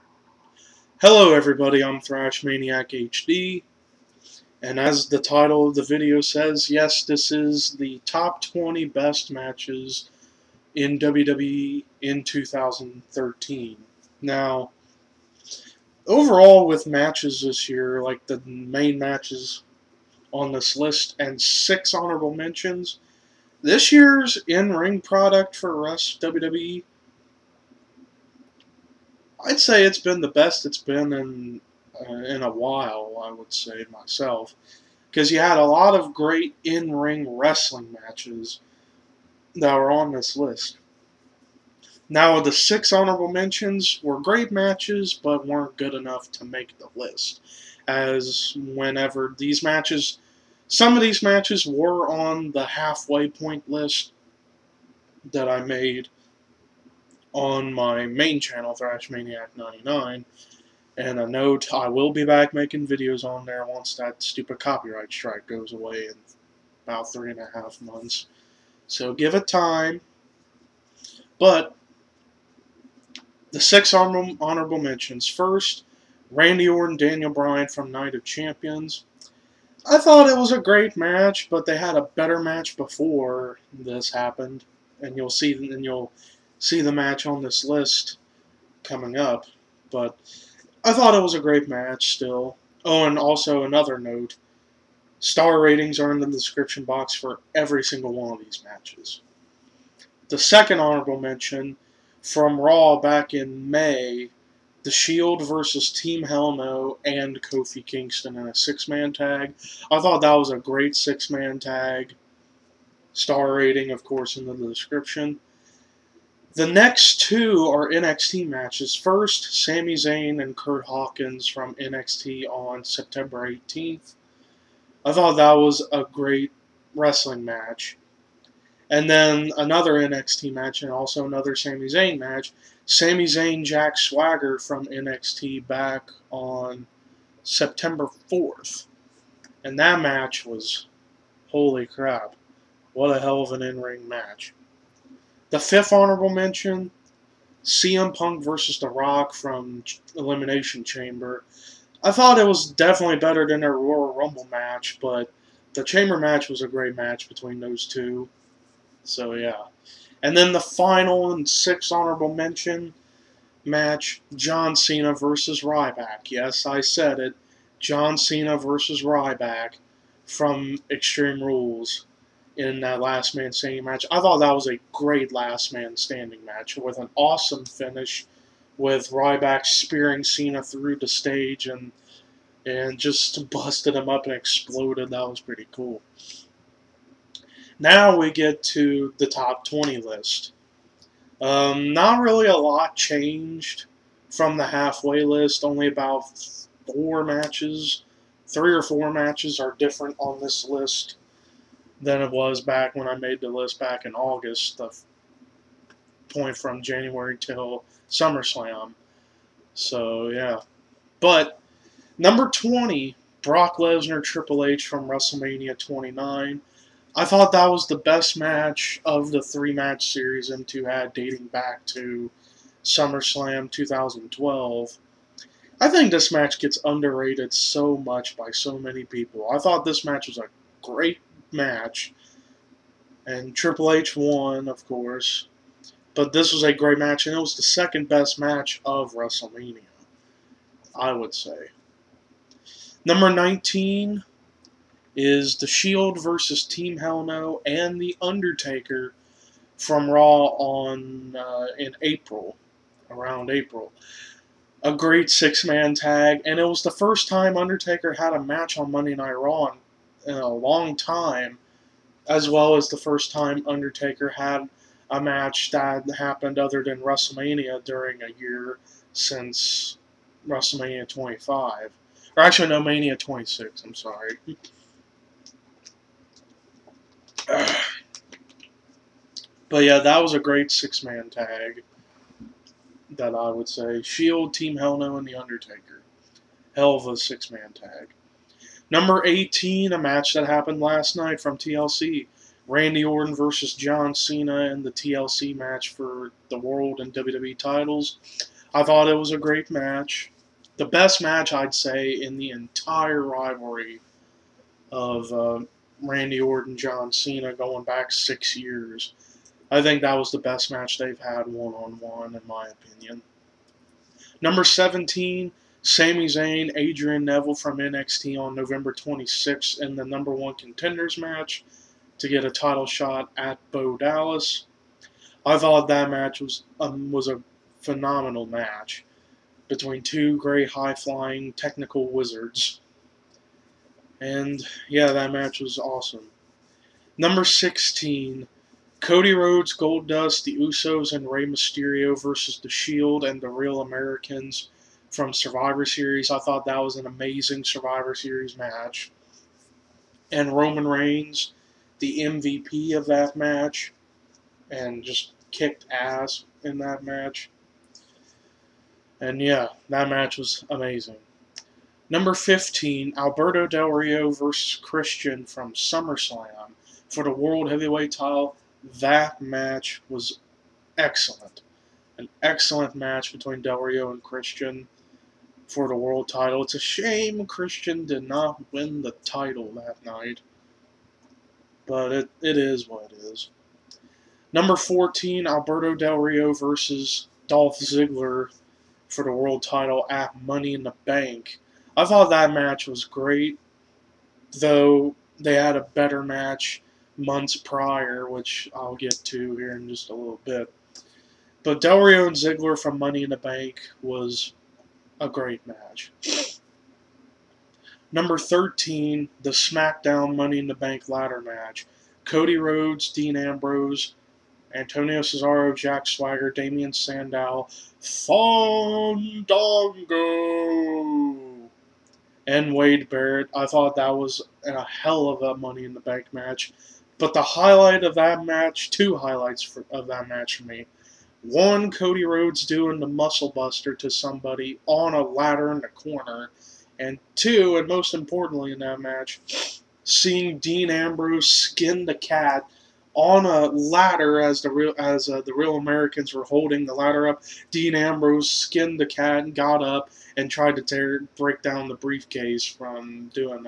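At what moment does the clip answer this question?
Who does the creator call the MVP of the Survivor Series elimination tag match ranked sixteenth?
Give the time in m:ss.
5:50.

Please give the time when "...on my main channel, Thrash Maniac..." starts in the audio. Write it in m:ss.
0:57.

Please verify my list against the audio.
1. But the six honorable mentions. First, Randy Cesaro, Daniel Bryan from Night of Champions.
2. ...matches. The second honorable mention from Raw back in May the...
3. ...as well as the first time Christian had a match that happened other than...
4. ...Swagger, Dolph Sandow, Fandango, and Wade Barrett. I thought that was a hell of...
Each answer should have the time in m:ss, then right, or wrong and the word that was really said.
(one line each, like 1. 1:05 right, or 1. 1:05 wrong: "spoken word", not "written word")
1. 1:11 wrong: "Orton", not "Cesaro"
2. 1:38 right
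3. 4:22 wrong: "Undertaker", not "Christian"
4. 6:56 wrong: "Damien", not "Dolph".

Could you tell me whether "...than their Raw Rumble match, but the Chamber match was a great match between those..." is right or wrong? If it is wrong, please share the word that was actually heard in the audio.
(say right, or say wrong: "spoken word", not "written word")
wrong: "Royal", not "Raw".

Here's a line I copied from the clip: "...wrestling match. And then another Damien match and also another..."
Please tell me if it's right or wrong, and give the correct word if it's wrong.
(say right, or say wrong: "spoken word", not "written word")
wrong: "NXT", not "Damien".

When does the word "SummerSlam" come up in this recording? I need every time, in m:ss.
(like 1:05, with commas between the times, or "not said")
3:28, 3:42, 6:05.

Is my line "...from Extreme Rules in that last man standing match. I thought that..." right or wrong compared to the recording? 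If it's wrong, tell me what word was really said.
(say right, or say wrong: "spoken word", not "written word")
right.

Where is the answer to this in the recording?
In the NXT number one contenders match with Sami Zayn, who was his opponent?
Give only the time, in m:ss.
5:16.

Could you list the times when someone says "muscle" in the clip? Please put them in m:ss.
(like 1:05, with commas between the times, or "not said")
7:13.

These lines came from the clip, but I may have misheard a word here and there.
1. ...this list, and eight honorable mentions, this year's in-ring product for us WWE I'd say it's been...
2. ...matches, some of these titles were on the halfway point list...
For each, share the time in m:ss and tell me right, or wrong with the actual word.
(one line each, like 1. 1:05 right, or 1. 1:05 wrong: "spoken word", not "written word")
1. 0:20 wrong: "six", not "eight"
2. 0:49 wrong: "matches", not "titles".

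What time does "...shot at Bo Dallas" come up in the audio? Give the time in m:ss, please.
5:22.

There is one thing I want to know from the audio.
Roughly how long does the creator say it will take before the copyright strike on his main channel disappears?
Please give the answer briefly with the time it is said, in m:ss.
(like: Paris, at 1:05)
3.5 months, at 1:07.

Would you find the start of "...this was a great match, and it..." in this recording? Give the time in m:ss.
3:56.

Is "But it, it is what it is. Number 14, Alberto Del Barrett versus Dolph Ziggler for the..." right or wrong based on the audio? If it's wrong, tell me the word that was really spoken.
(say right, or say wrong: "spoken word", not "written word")
wrong: "Rio", not "Barrett".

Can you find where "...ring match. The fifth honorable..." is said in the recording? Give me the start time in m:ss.
2:23.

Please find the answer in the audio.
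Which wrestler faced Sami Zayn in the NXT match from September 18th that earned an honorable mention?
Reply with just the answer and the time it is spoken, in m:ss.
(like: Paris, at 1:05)
Kurt Hawkins, at 2:00.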